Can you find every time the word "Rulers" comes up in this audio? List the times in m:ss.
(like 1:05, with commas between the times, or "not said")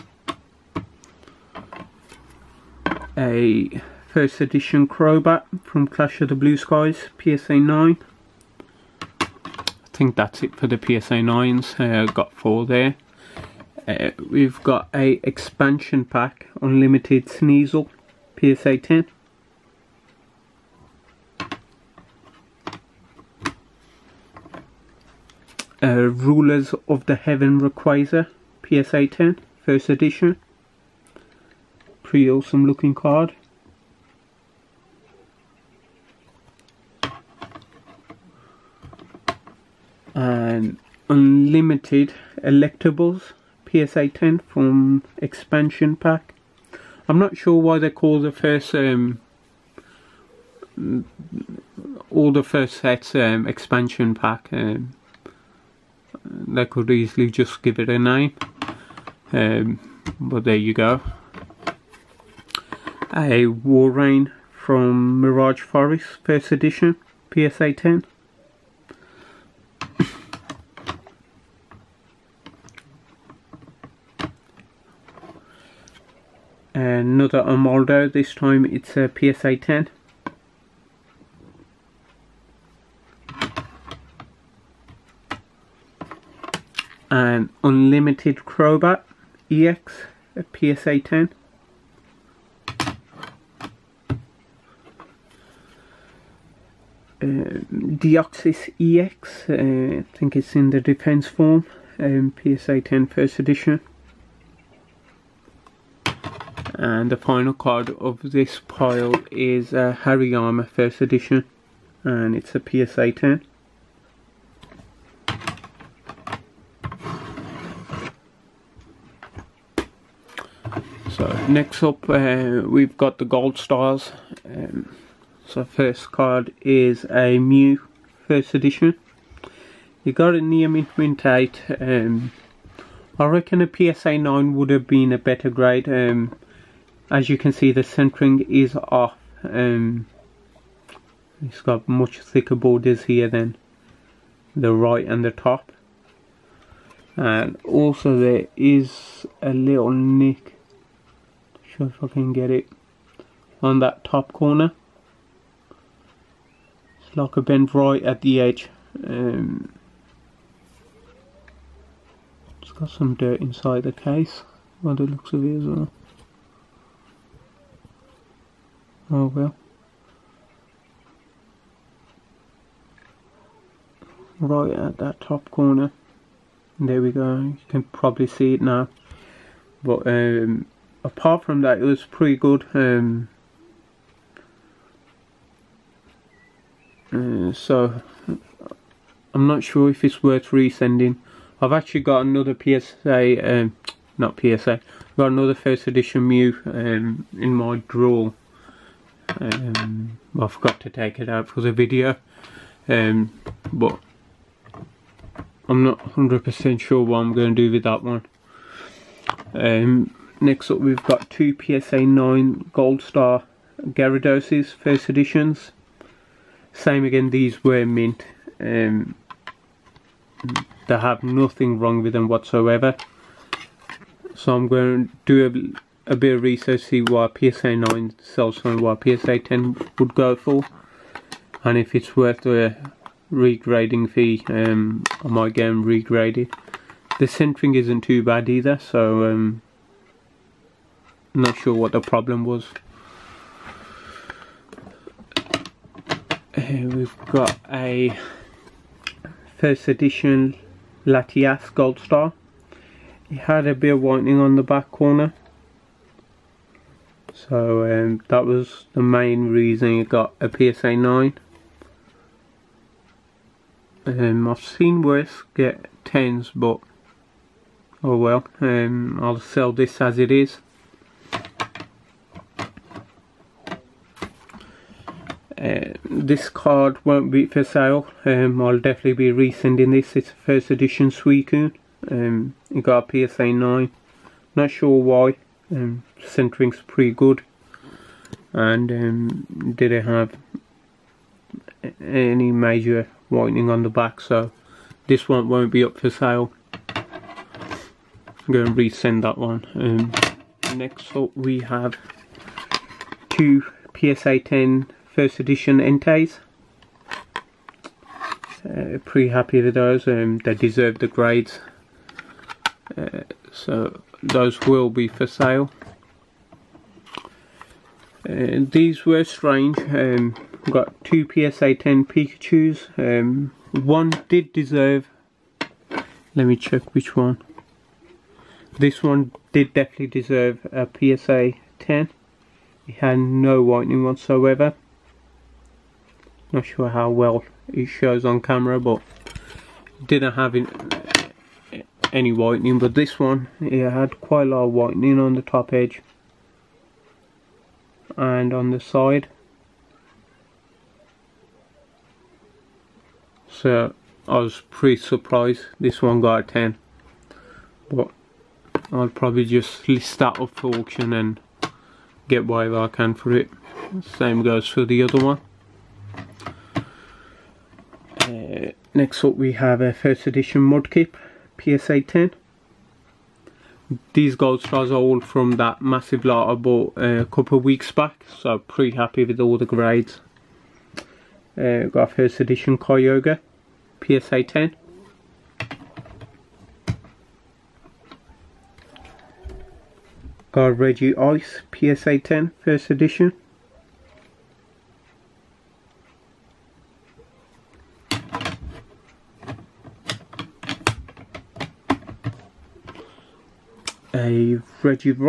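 0:26.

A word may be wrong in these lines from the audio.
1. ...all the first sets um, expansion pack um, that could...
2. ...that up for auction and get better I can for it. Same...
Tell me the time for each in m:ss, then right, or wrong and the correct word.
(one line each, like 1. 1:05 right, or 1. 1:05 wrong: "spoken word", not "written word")
1. 0:52 right
2. 6:00 wrong: "whatever", not "better".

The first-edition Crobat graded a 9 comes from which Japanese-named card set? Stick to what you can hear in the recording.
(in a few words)
Clash of the Blue Skies.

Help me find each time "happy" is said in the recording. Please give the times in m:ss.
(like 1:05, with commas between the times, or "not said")
5:09, 6:18.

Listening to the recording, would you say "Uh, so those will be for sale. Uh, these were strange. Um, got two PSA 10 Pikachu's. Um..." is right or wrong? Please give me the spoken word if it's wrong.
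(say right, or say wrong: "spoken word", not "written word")
right.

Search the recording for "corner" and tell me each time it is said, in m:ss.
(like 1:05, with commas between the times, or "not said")
2:34, 2:55, 4:14.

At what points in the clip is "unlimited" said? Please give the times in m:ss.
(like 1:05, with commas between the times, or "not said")
0:16, 0:41, 1:27.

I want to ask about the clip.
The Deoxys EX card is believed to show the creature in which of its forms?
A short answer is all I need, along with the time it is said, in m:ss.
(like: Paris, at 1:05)
Defense form, at 1:40.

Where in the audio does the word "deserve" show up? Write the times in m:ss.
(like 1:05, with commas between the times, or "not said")
5:10, 5:24, 5:30.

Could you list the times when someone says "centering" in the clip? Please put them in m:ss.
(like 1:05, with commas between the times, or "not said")
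2:17, 3:57, 4:46.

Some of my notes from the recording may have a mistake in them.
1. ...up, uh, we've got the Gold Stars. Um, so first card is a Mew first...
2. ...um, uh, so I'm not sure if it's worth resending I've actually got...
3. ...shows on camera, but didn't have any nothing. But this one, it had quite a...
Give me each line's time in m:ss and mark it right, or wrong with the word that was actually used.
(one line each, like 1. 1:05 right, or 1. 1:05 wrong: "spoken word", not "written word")
1. 2:01 right
2. 3:02 right
3. 5:37 wrong: "whitening", not "nothing".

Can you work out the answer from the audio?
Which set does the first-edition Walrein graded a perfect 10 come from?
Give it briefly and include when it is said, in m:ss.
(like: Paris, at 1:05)
Mirage Forest, at 1:05.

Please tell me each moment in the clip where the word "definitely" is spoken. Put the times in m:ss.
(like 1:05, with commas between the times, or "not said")
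4:38, 5:29.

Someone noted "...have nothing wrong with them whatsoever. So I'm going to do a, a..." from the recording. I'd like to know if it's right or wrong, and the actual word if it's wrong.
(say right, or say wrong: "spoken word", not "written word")
right.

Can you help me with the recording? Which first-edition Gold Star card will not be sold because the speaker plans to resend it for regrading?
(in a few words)
Suicune.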